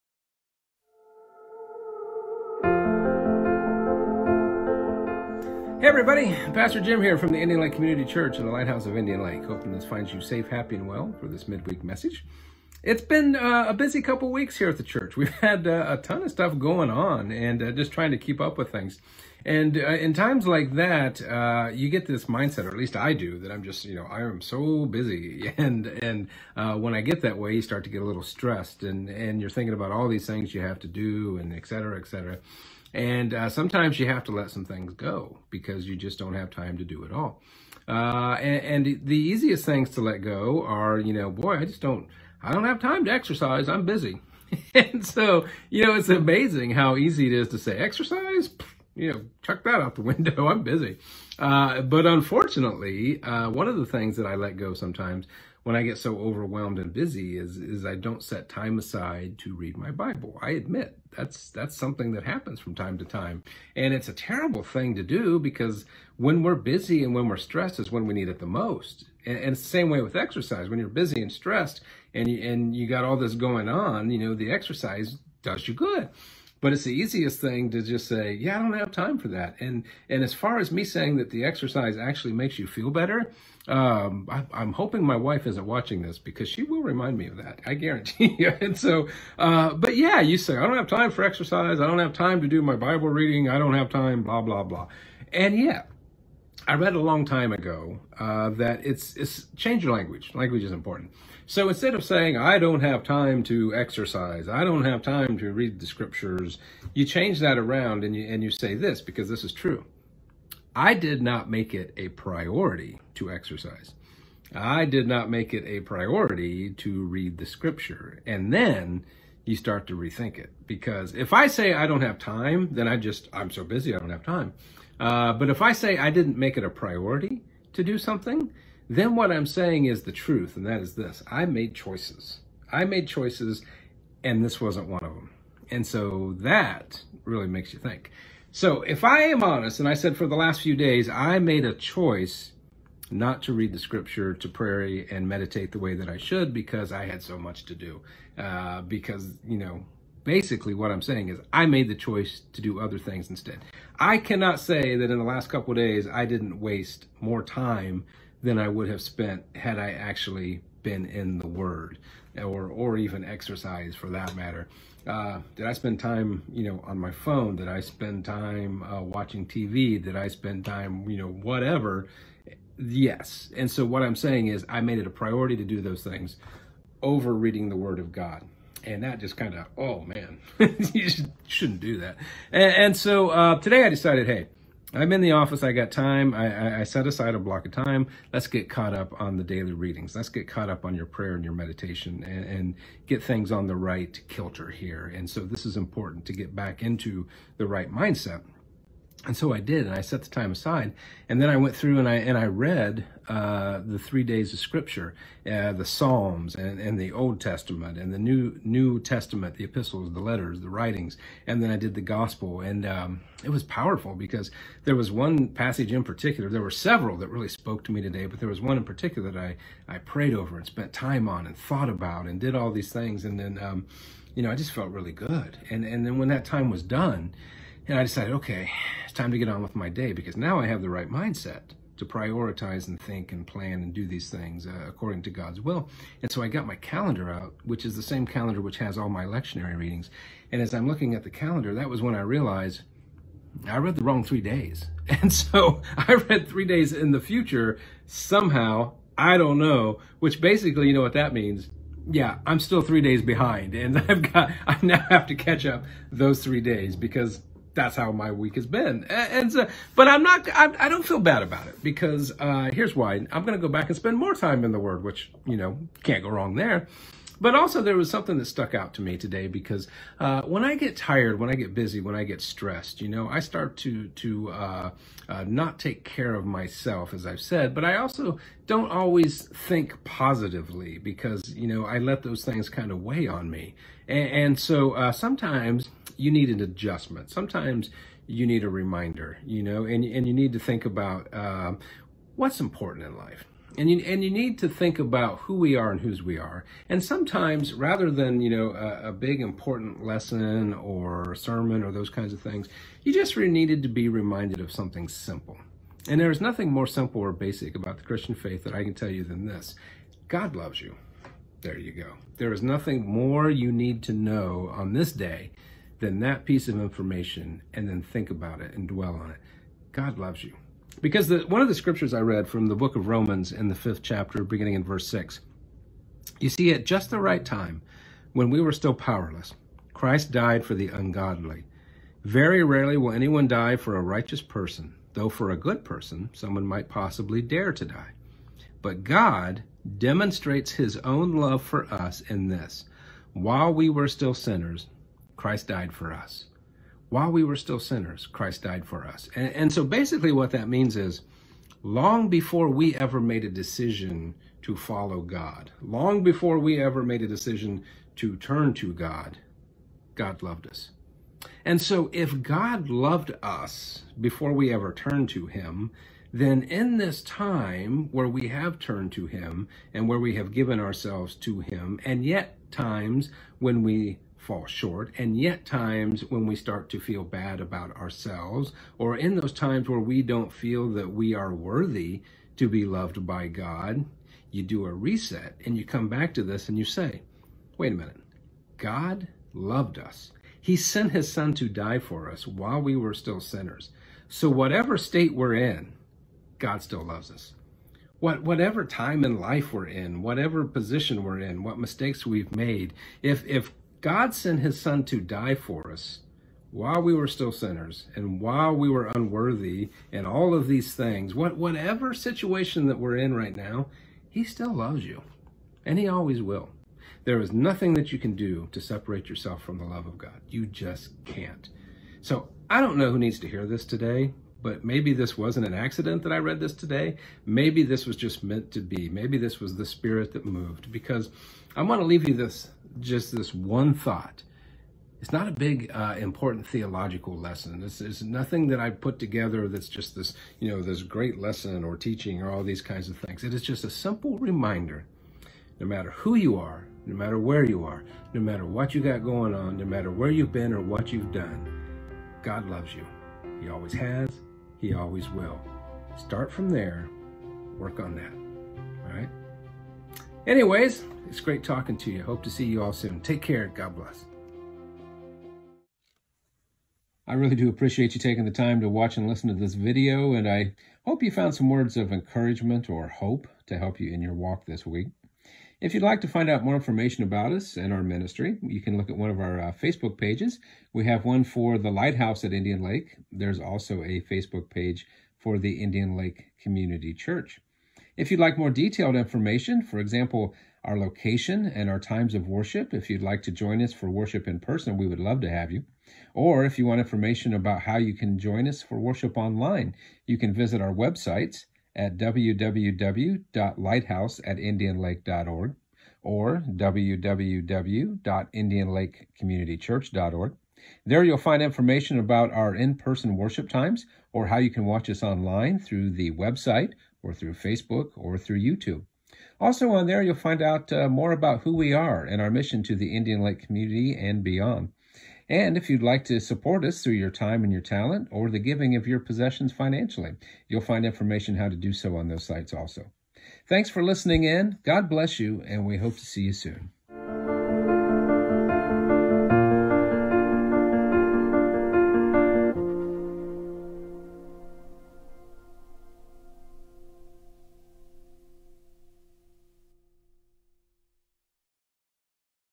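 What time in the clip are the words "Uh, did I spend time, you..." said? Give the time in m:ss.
2:45.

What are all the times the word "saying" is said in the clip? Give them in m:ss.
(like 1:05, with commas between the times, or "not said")
1:20, 1:42, 2:09, 2:31, 2:54.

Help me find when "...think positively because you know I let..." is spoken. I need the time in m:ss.
4:39.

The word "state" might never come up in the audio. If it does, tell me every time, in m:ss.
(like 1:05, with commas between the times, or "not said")
6:34.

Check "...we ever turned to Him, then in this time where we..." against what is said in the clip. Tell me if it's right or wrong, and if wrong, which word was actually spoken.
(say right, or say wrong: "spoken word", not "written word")
right.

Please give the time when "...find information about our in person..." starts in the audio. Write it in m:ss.
8:31.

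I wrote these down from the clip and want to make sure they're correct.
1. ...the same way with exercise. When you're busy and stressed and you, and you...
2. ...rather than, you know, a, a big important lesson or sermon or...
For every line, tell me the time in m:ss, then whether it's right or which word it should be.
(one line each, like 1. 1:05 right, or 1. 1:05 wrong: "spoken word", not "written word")
1. 1:09 right
2. 4:57 right.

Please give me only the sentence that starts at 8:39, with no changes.
Also, on there, you'll find out uh, more about who we are and our mission to the Indian Lake community and beyond.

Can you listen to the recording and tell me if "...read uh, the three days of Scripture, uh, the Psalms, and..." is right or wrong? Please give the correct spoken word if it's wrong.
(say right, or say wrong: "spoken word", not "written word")
right.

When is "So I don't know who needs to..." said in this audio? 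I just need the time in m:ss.
7:02.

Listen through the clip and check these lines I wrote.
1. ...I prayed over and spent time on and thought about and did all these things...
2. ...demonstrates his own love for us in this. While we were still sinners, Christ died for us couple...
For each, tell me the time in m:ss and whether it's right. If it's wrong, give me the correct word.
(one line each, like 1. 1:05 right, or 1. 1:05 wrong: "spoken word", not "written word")
1. 3:39 right
2. 5:39 wrong: "while", not "couple".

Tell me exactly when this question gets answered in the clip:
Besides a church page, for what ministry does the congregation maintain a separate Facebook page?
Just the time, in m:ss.
8:01.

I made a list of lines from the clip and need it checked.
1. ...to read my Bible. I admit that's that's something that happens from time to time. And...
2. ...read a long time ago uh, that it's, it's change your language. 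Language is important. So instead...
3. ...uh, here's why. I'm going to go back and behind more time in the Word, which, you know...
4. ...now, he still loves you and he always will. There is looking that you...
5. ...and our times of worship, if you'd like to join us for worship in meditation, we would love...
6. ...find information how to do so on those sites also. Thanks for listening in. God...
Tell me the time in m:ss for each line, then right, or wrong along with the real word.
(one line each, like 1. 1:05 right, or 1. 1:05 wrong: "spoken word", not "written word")
1. 0:59 right
2. 1:36 right
3. 4:22 wrong: "spend", not "behind"
4. 6:53 wrong: "nothing", not "looking"
5. 8:11 wrong: "person", not "meditation"
6. 8:50 right.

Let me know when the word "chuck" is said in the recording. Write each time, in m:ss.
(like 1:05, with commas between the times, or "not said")
0:49.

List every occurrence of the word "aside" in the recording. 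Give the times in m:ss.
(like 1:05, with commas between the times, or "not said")
0:58, 3:07, 3:20.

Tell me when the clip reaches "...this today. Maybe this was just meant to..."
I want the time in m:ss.
7:06.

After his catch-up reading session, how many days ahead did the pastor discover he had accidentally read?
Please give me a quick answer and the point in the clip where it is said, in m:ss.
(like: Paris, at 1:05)
3, at 4:06.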